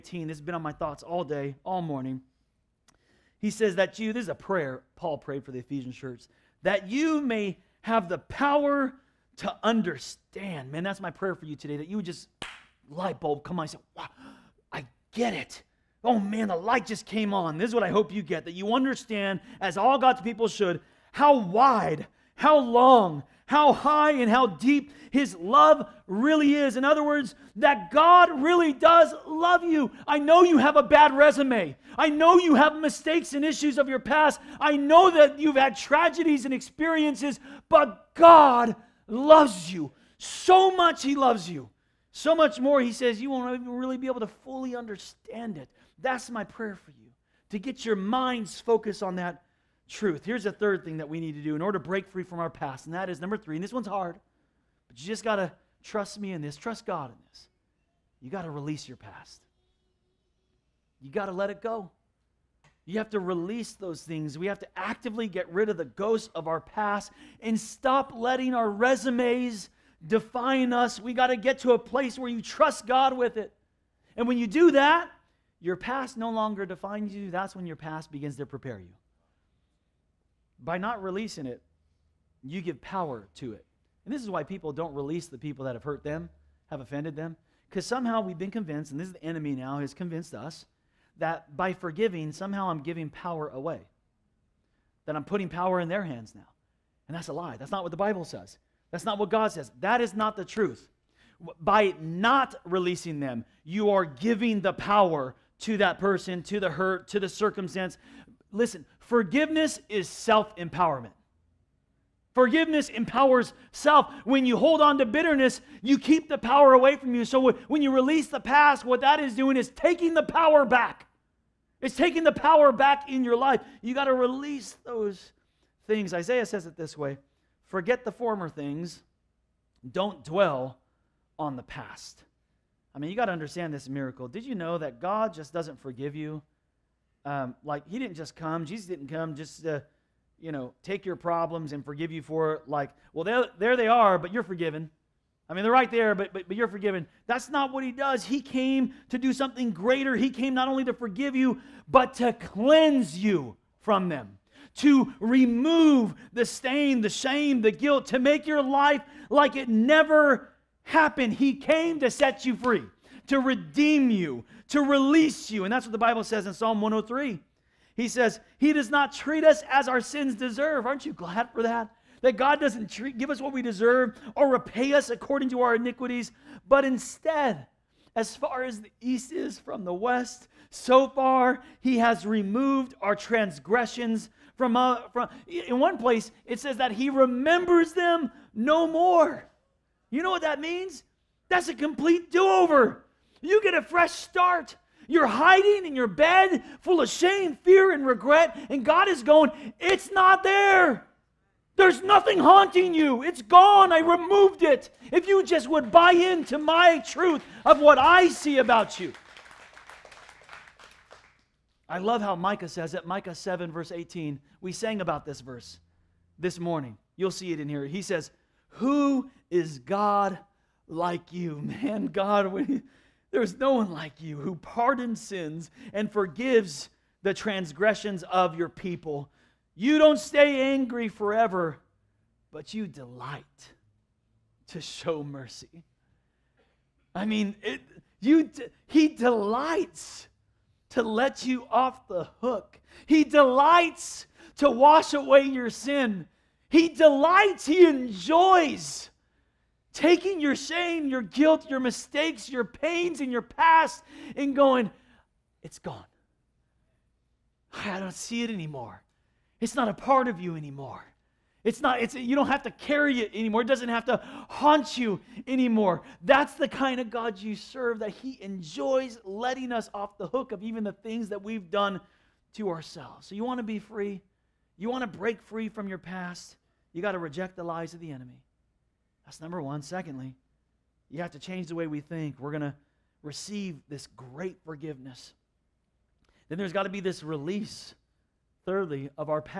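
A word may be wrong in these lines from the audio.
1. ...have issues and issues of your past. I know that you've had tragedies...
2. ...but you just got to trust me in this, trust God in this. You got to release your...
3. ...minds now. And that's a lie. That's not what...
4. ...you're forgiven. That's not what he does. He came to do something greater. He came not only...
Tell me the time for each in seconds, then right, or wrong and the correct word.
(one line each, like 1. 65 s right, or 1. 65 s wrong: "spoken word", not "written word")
1. 32 s wrong: "mistakes", not "issues"
2. 54 s right
3. 96 s wrong: "hands", not "minds"
4. 146 s right.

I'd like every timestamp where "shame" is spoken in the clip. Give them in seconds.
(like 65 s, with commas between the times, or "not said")
157 s, 197 s, 250 s.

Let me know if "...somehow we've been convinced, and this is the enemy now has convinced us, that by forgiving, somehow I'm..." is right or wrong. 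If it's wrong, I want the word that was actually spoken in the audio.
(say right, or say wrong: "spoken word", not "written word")
right.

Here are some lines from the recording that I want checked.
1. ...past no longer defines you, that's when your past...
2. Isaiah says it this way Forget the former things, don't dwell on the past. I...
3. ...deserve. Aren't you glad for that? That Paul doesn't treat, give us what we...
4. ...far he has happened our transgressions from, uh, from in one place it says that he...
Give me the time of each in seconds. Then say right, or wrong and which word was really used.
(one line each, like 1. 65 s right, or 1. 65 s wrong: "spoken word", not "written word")
1. 75 s right
2. 126 s right
3. 170 s wrong: "God", not "Paul"
4. 181 s wrong: "removed", not "happened".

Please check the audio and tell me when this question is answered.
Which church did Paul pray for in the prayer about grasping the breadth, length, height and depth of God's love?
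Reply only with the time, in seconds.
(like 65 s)
5 s.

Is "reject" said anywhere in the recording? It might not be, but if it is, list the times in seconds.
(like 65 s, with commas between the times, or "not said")
277 s.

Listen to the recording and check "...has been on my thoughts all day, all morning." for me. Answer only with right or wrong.
right.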